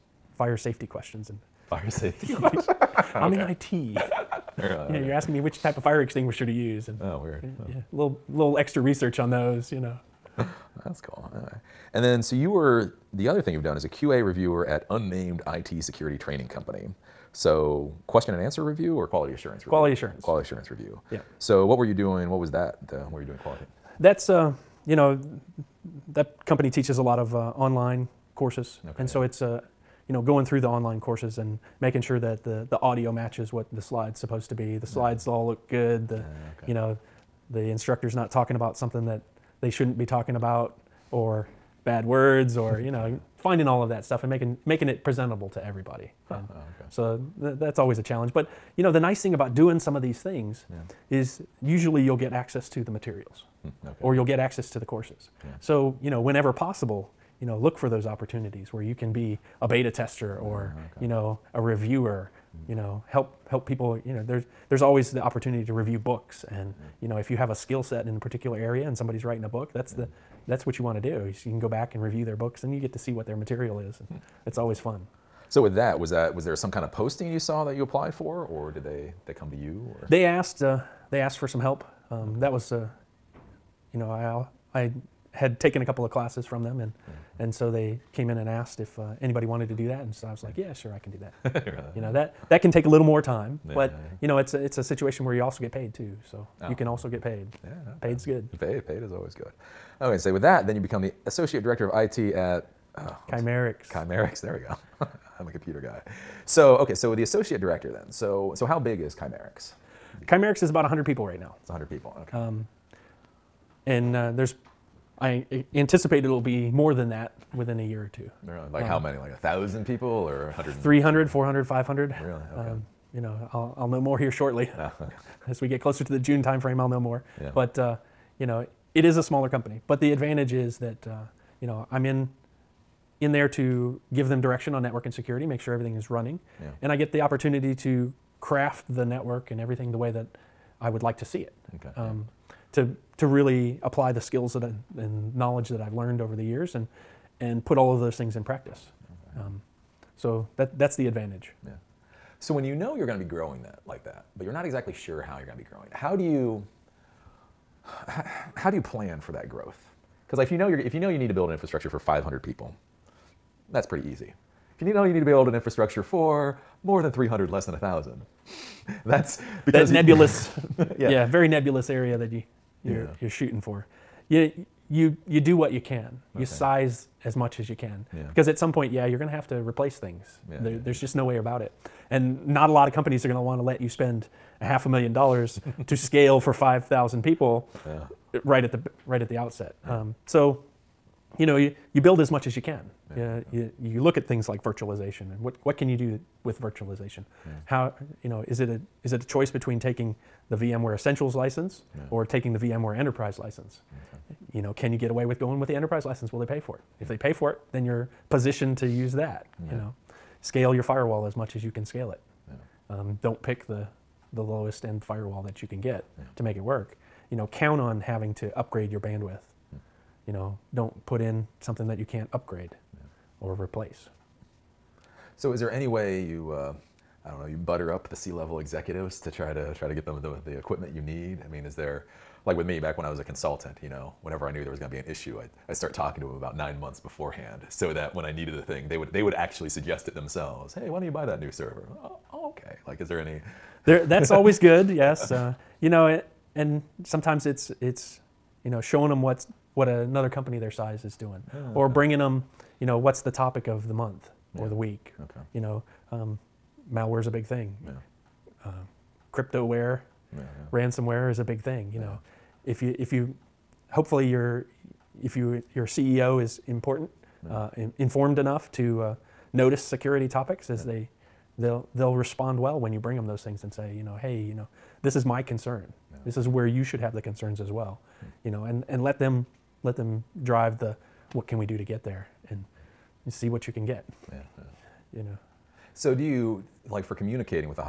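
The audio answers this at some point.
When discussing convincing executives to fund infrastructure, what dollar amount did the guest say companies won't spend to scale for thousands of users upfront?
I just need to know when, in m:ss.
3:04.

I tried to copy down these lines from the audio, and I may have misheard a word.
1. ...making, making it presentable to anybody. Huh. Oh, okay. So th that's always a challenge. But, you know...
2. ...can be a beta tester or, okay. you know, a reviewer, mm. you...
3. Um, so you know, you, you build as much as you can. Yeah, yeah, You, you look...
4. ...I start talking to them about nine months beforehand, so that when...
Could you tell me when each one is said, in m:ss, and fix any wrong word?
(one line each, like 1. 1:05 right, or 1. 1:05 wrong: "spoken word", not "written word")
1. 0:44 wrong: "everybody", not "anybody"
2. 0:58 right
3. 3:09 right
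4. 3:55 right.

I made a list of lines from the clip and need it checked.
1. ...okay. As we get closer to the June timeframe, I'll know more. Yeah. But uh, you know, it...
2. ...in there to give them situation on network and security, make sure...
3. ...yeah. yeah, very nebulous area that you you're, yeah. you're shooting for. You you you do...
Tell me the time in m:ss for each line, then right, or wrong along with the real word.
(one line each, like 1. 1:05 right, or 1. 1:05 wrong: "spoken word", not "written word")
1. 2:04 right
2. 2:13 wrong: "direction", not "situation"
3. 2:50 right.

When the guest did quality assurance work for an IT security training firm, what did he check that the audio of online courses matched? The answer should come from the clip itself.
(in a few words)
The slides.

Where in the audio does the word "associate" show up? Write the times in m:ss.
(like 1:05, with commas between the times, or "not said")
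1:41, 1:47.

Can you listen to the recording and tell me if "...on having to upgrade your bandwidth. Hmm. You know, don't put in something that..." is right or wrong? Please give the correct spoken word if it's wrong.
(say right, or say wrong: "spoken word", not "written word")
right.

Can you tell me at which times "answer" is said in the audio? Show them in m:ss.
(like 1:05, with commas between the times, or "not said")
0:18.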